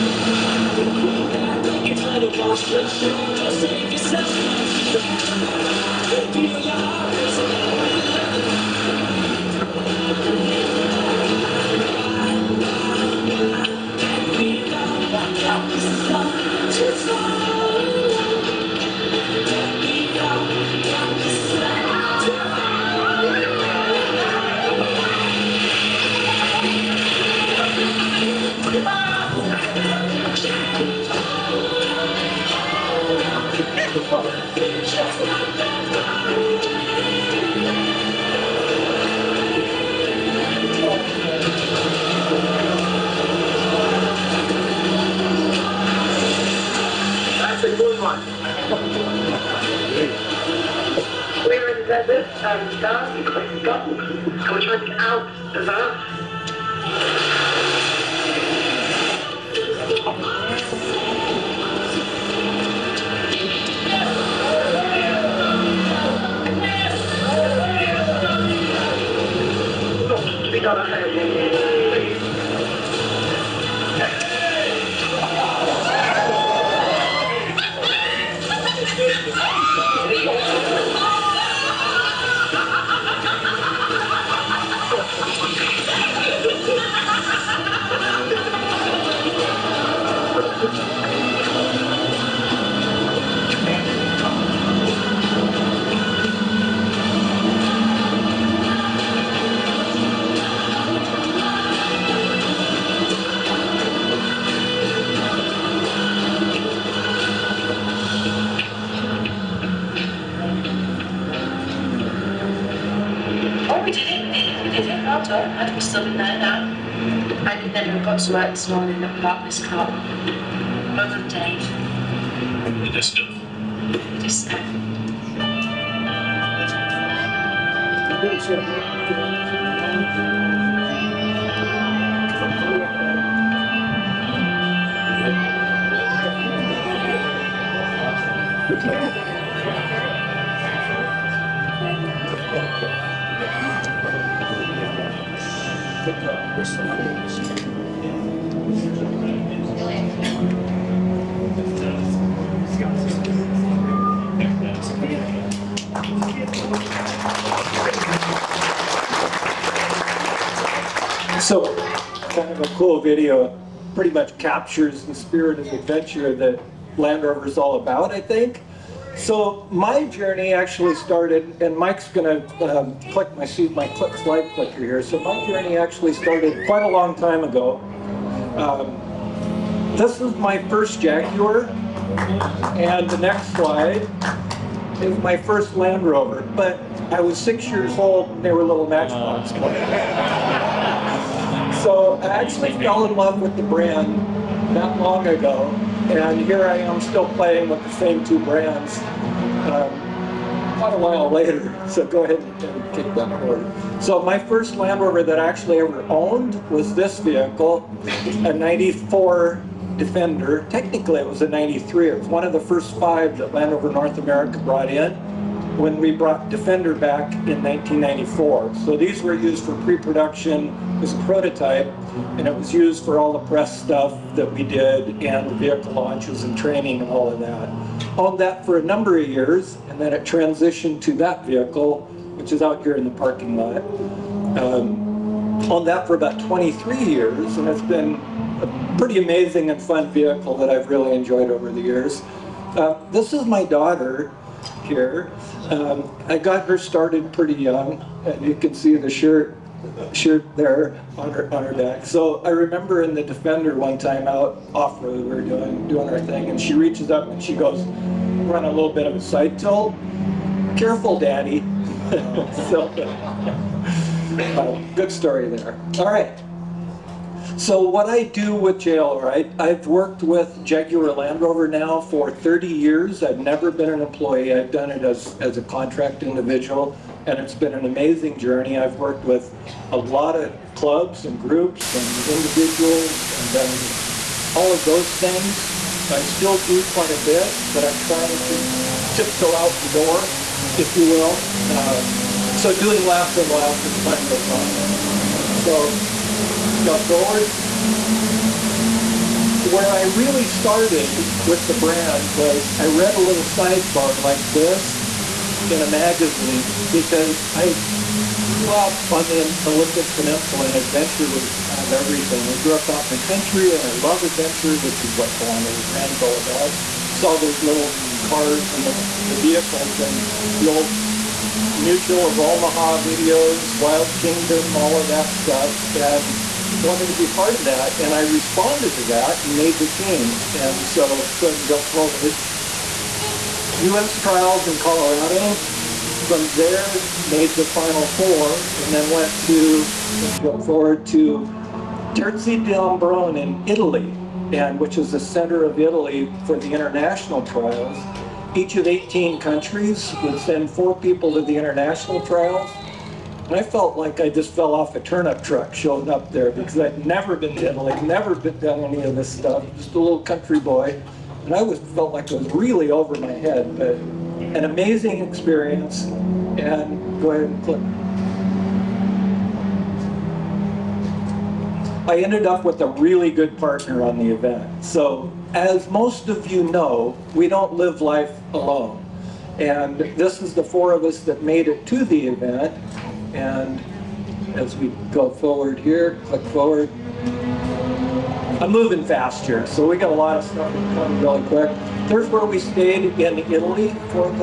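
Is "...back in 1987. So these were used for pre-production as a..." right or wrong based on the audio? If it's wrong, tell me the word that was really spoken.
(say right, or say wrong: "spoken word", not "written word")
wrong: "1994", not "1987".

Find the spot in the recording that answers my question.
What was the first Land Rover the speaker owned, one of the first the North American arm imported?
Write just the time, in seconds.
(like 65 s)
208 s.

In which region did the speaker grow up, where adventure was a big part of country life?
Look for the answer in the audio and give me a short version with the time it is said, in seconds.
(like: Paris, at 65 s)
Olympic Peninsula, at 309 s.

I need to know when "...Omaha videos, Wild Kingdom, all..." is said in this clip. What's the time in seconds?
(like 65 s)
322 s.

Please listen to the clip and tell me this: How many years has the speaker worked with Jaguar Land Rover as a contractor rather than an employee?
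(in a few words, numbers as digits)
30.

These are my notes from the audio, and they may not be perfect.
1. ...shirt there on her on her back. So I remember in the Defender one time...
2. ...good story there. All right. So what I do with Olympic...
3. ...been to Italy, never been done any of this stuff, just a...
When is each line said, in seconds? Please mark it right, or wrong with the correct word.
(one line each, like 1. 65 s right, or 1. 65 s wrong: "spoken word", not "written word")
1. 250 s right
2. 264 s wrong: "JLRight", not "Olympic"
3. 357 s right.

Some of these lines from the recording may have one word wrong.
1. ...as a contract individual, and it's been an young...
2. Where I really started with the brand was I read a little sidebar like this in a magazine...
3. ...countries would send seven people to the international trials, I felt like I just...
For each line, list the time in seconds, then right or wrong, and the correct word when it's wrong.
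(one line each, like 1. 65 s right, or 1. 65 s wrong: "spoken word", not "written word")
1. 275 s wrong: "amazing", not "young"
2. 299 s right
3. 349 s wrong: "four", not "seven".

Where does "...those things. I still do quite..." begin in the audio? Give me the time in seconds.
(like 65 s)
284 s.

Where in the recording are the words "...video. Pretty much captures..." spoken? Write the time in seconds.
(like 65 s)
162 s.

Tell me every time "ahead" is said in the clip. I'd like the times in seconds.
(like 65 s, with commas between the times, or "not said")
202 s, 367 s.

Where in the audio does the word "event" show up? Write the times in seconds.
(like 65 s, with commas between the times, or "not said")
374 s, 382 s.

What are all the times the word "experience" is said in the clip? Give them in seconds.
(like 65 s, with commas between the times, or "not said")
365 s.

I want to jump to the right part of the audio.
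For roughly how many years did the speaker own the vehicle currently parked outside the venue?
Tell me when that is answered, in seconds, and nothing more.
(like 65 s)
236 s.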